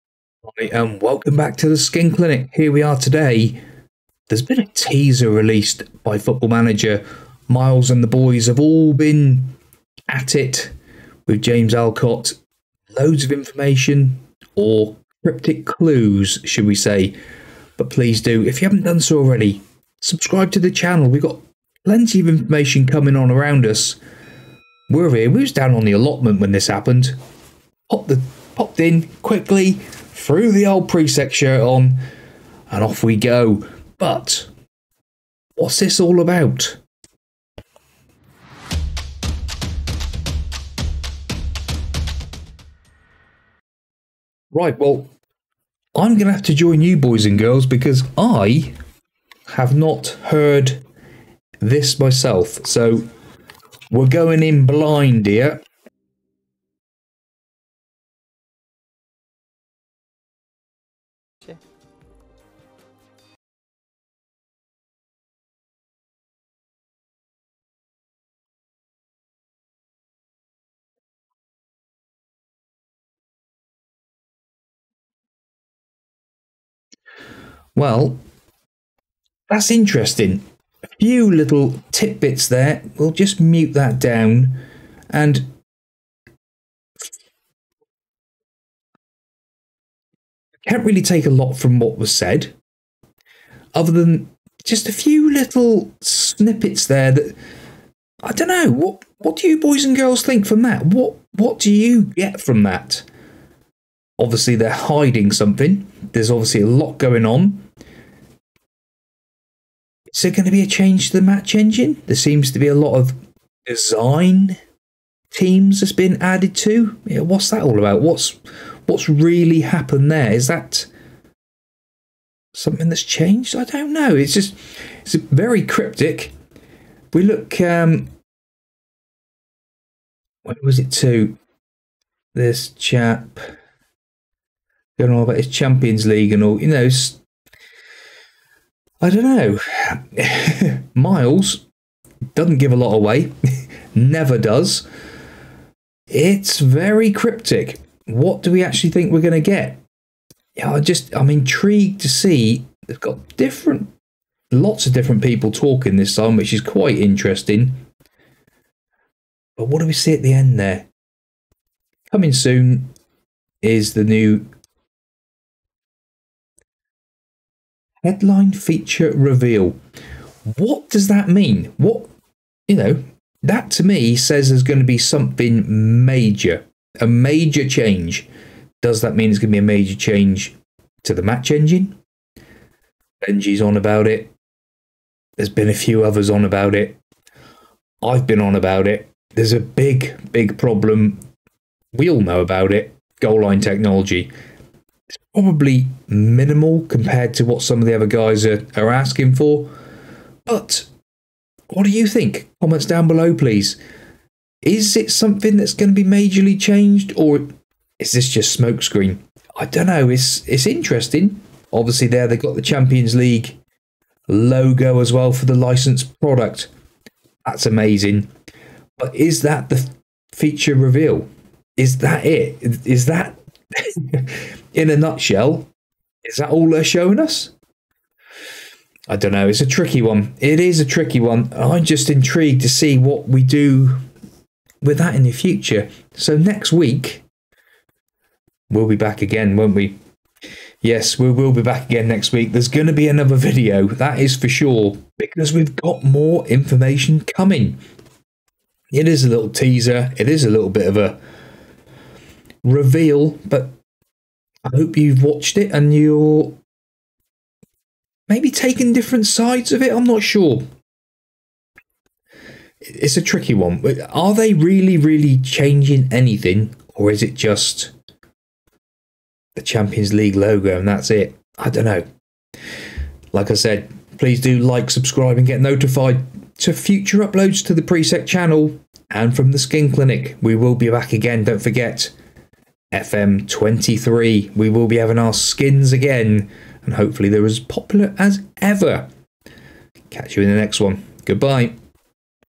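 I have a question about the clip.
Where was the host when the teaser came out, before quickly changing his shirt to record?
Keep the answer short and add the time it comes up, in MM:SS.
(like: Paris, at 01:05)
the allotment, at 00:25.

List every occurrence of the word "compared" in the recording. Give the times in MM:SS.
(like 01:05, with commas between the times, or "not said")
03:16.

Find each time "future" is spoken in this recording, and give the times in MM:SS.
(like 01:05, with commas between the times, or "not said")
03:55, 04:36.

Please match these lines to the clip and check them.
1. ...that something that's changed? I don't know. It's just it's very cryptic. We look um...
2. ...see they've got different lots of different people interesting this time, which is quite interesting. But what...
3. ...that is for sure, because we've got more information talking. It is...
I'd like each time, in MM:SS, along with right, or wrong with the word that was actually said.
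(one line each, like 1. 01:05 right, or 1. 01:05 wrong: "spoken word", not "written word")
1. 02:00 right
2. 02:32 wrong: "talking", not "interesting"
3. 04:03 wrong: "coming", not "talking".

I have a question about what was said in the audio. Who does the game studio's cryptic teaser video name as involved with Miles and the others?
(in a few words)
James Alcott.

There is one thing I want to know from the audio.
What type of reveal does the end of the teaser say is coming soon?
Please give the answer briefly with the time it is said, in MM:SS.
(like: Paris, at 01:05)
Headline feature reveal, at 02:48.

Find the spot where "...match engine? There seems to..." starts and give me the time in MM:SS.
01:51.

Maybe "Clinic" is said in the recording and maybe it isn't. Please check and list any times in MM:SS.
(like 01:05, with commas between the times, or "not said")
00:02, 04:39.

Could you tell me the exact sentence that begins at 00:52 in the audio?
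So we're going in blind here.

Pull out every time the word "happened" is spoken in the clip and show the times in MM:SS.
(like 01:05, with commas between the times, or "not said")
00:26, 01:59.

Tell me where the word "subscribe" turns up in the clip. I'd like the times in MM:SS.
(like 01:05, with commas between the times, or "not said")
00:20, 04:34.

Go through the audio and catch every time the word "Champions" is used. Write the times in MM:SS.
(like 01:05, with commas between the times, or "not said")
02:15, 03:32, 04:29.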